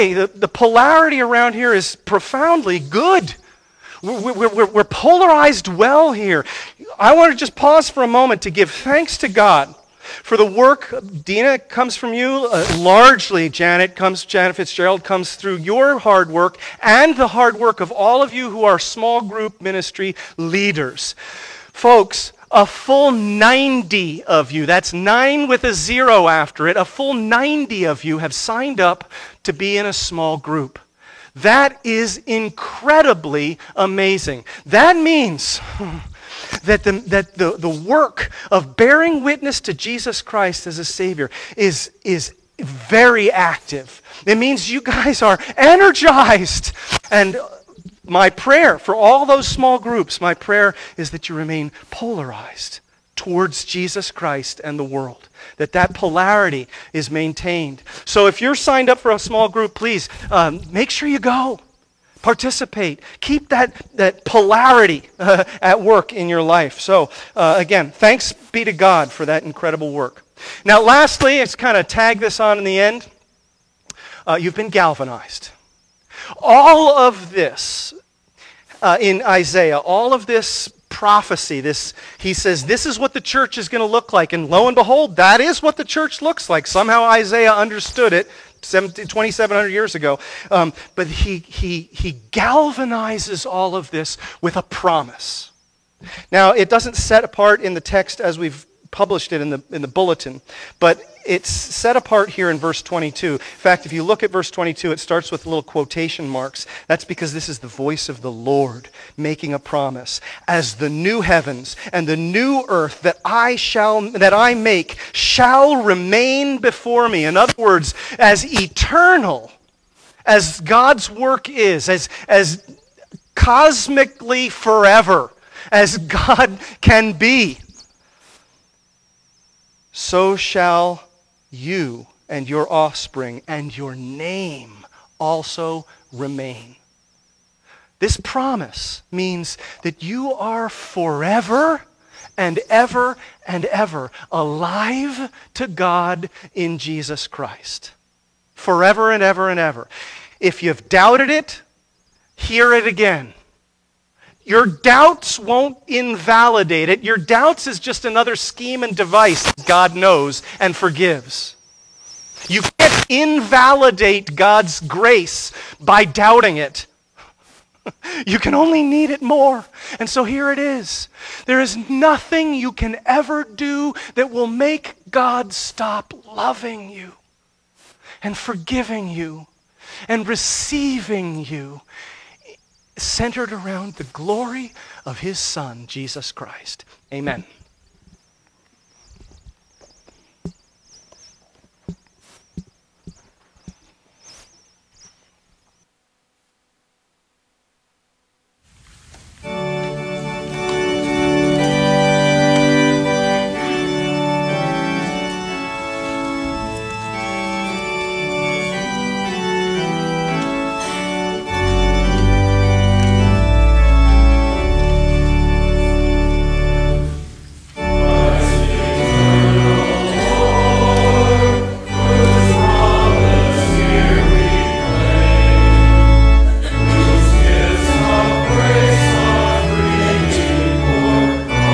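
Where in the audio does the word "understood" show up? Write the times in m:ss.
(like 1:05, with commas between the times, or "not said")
1:27.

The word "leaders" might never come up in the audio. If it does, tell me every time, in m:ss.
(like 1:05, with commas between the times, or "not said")
0:20.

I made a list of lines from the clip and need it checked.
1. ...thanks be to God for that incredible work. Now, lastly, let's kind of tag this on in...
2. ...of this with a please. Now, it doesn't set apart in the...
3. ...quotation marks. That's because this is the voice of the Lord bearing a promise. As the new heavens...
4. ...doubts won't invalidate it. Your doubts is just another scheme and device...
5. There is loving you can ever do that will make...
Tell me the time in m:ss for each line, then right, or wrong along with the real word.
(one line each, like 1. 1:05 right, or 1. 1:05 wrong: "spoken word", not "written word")
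1. 1:07 right
2. 1:33 wrong: "promise", not "please"
3. 1:45 wrong: "making", not "bearing"
4. 2:34 right
5. 2:51 wrong: "nothing", not "loving".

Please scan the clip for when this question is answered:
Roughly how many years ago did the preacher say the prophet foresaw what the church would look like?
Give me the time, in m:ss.
1:28.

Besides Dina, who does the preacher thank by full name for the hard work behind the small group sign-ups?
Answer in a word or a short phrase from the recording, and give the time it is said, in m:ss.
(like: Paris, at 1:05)
Janet Fitzgerald, at 0:14.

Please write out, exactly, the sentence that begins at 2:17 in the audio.
This promise means that you are forever and ever and ever alive to God in Jesus Christ.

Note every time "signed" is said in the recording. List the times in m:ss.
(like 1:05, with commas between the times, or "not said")
0:28, 0:58.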